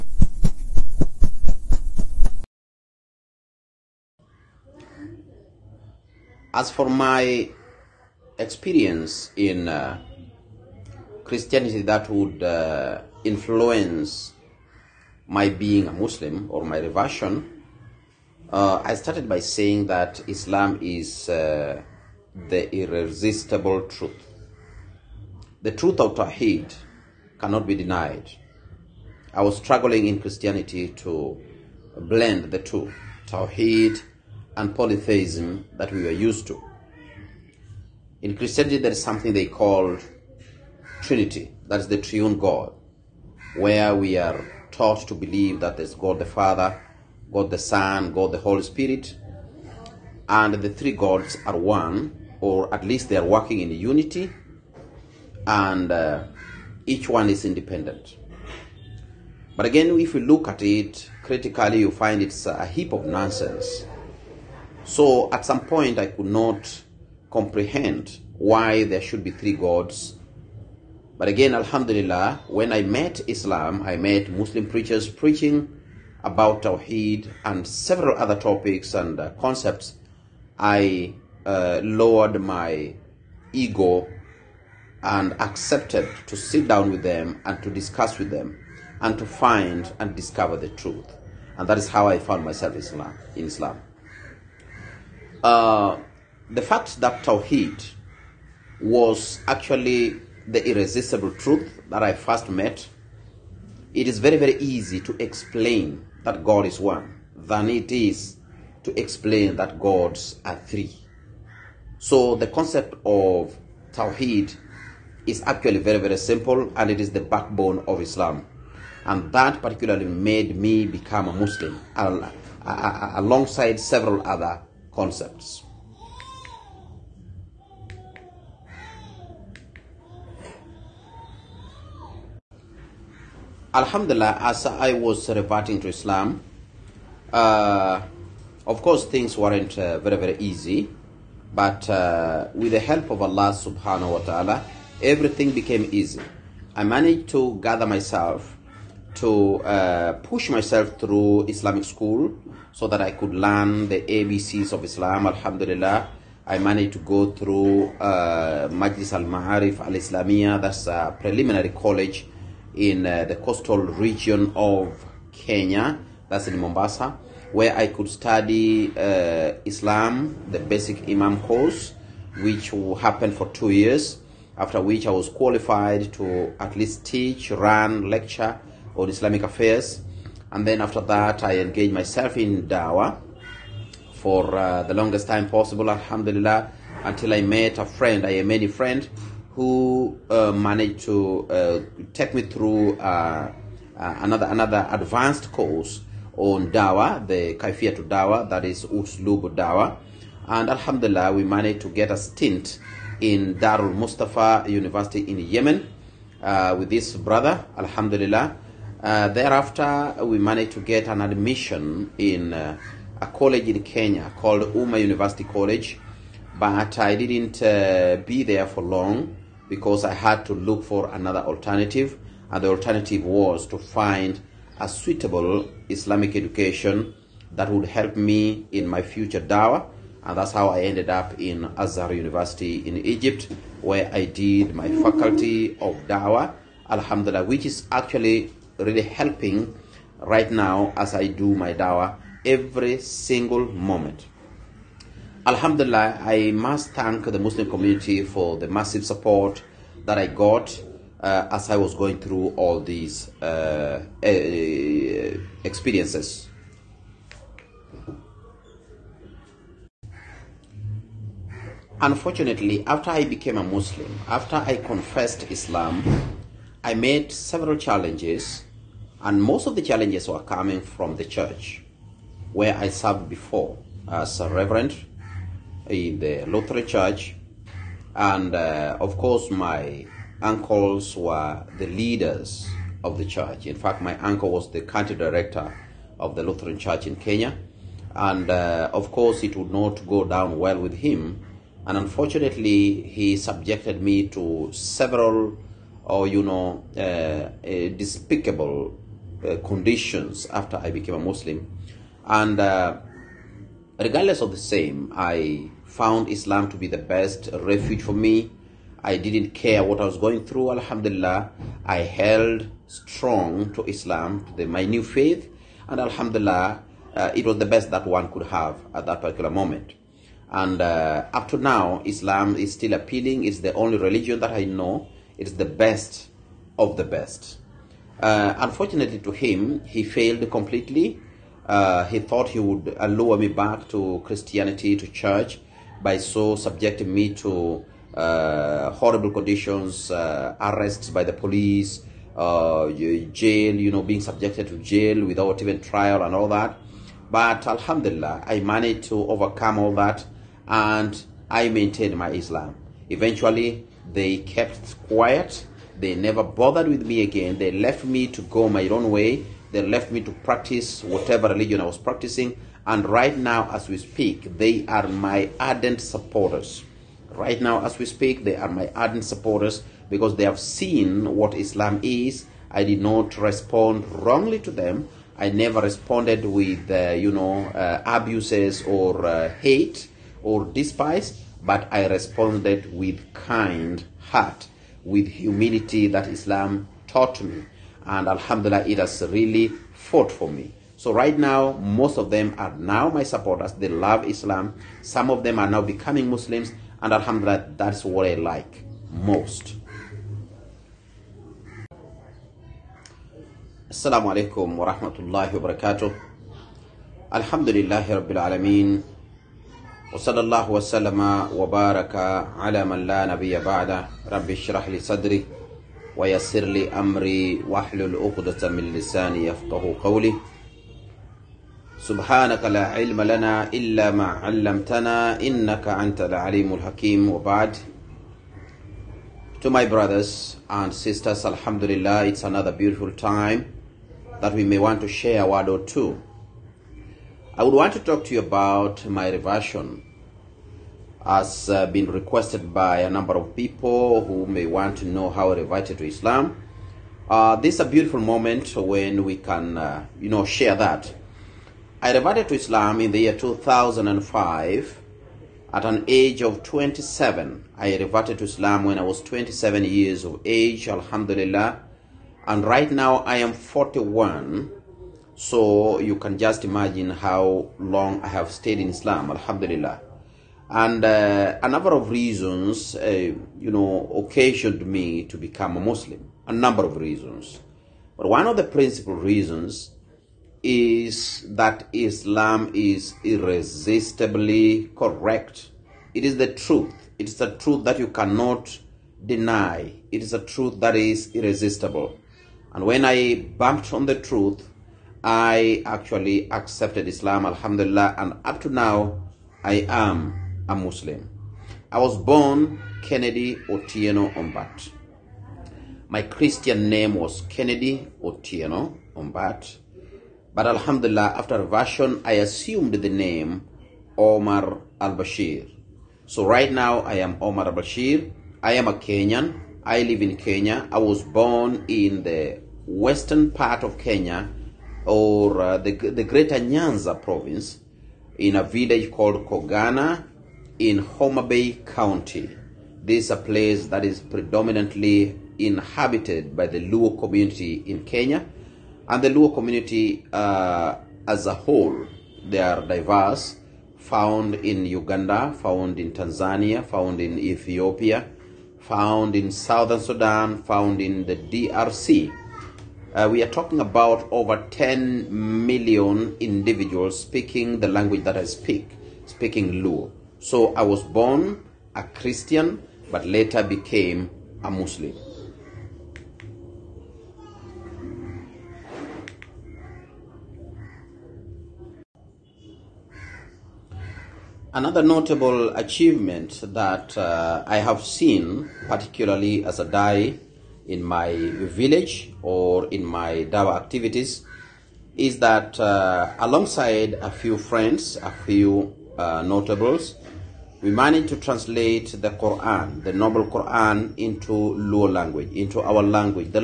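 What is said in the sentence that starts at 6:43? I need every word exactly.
Assalamu alaikum wa rahmatullahi wa barakatuh.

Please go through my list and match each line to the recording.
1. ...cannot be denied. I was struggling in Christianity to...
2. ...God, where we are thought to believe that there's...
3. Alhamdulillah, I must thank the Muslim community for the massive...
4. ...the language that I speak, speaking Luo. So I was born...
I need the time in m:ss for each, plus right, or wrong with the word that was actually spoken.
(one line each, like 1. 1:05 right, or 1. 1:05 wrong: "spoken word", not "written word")
1. 0:27 right
2. 0:42 wrong: "taught", not "thought"
3. 4:05 right
4. 9:17 right.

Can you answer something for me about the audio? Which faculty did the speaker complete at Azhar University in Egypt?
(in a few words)
faculty of dawah.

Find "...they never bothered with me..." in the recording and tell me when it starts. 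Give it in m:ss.
5:55.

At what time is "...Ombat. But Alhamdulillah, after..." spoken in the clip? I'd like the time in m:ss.
8:29.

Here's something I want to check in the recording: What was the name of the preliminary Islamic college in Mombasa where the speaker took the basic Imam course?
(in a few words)
Majlis Al Ma'arif Al Islamiyah.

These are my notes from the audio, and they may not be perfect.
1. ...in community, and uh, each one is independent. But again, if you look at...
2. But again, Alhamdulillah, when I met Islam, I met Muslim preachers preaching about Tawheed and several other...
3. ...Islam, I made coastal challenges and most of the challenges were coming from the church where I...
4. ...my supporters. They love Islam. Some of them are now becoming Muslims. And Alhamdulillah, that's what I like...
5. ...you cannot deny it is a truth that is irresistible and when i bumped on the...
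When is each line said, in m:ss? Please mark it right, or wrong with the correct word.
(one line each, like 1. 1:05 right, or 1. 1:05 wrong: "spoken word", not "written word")
1. 0:53 wrong: "unity", not "community"
2. 1:11 right
3. 4:25 wrong: "several", not "coastal"
4. 6:33 right
5. 8:07 right.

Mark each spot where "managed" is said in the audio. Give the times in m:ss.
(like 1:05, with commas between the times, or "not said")
2:26, 2:36, 3:10, 3:21, 3:30, 5:48, 9:50.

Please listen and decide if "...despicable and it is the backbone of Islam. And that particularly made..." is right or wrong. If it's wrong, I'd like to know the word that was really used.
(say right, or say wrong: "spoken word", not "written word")
wrong: "simple", not "despicable".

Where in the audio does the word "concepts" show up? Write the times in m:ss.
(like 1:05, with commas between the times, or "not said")
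1:19, 1:52, 2:04.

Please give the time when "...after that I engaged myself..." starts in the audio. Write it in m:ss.
3:00.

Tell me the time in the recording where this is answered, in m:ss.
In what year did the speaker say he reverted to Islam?
7:33.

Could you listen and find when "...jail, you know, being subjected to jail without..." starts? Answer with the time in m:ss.
5:42.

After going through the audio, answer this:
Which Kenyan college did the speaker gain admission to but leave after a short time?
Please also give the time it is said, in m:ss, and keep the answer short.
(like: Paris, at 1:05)
Umma University College, at 3:34.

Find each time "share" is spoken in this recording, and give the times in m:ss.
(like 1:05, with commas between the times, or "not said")
7:15, 7:30.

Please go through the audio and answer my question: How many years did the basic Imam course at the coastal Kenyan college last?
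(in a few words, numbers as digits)
2.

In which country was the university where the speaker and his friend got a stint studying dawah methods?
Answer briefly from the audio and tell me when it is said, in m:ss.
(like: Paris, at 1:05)
Yemen, at 3:25.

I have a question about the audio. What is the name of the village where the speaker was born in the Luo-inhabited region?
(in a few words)
Kogana.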